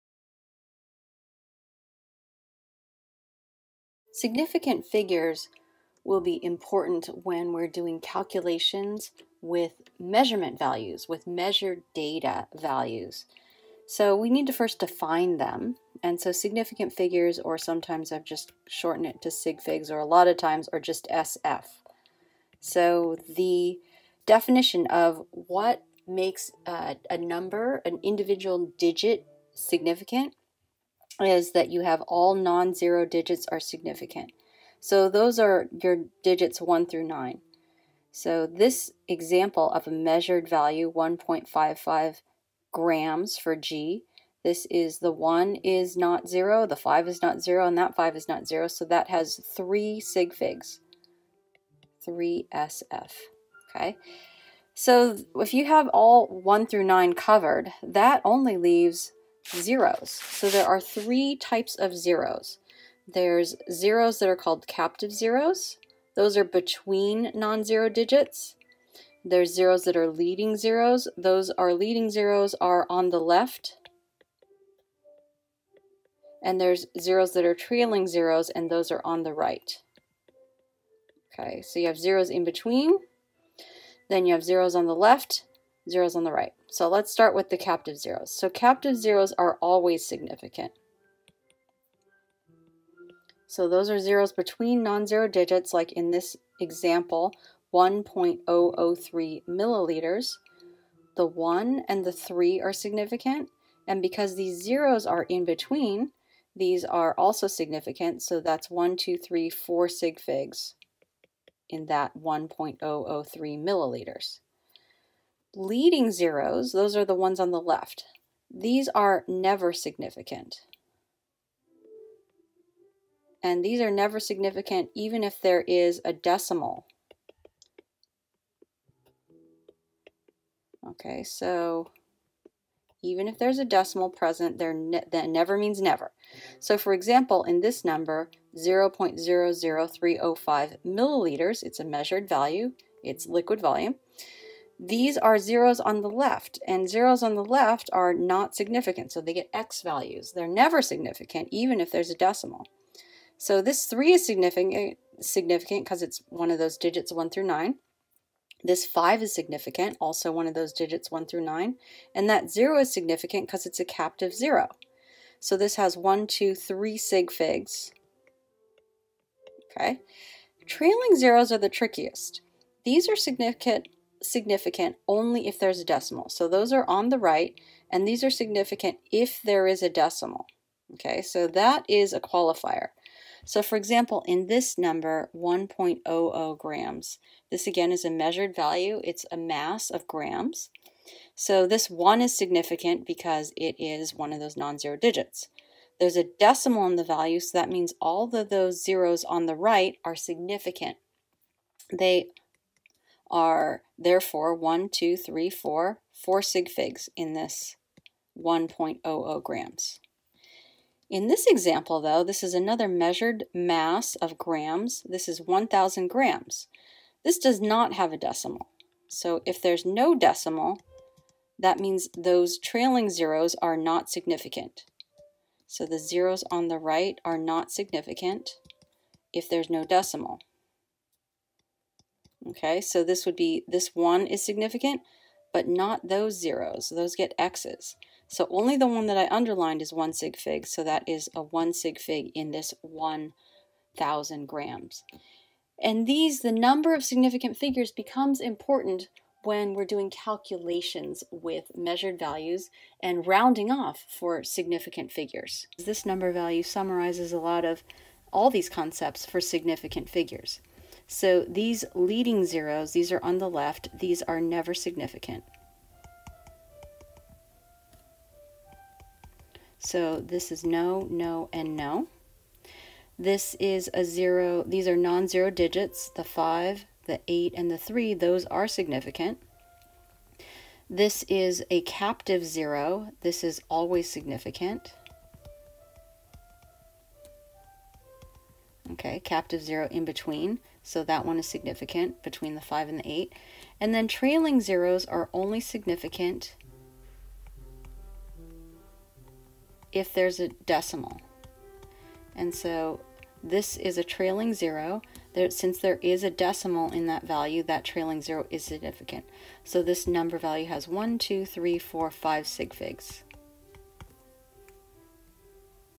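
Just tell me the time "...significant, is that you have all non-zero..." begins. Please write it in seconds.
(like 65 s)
29 s.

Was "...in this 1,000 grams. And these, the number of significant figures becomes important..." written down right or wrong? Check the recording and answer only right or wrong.
right.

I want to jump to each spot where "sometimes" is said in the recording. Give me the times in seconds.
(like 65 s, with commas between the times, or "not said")
17 s.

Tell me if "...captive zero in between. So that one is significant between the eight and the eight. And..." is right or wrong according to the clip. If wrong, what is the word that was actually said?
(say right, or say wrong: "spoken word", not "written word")
wrong: "five", not "eight".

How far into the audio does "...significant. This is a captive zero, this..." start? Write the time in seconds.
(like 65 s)
278 s.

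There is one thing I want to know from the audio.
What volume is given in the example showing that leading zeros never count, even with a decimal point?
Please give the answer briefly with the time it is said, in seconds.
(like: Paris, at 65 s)
0.00305 milliliters, at 138 s.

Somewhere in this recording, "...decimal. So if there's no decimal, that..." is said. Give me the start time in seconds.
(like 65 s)
218 s.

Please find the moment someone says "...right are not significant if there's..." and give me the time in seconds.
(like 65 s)
226 s.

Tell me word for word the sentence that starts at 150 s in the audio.
They're never significant, even if there's a decimal.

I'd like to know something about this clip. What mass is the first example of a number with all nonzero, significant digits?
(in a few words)
1.55 grams.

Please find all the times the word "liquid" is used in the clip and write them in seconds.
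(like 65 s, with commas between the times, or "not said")
143 s.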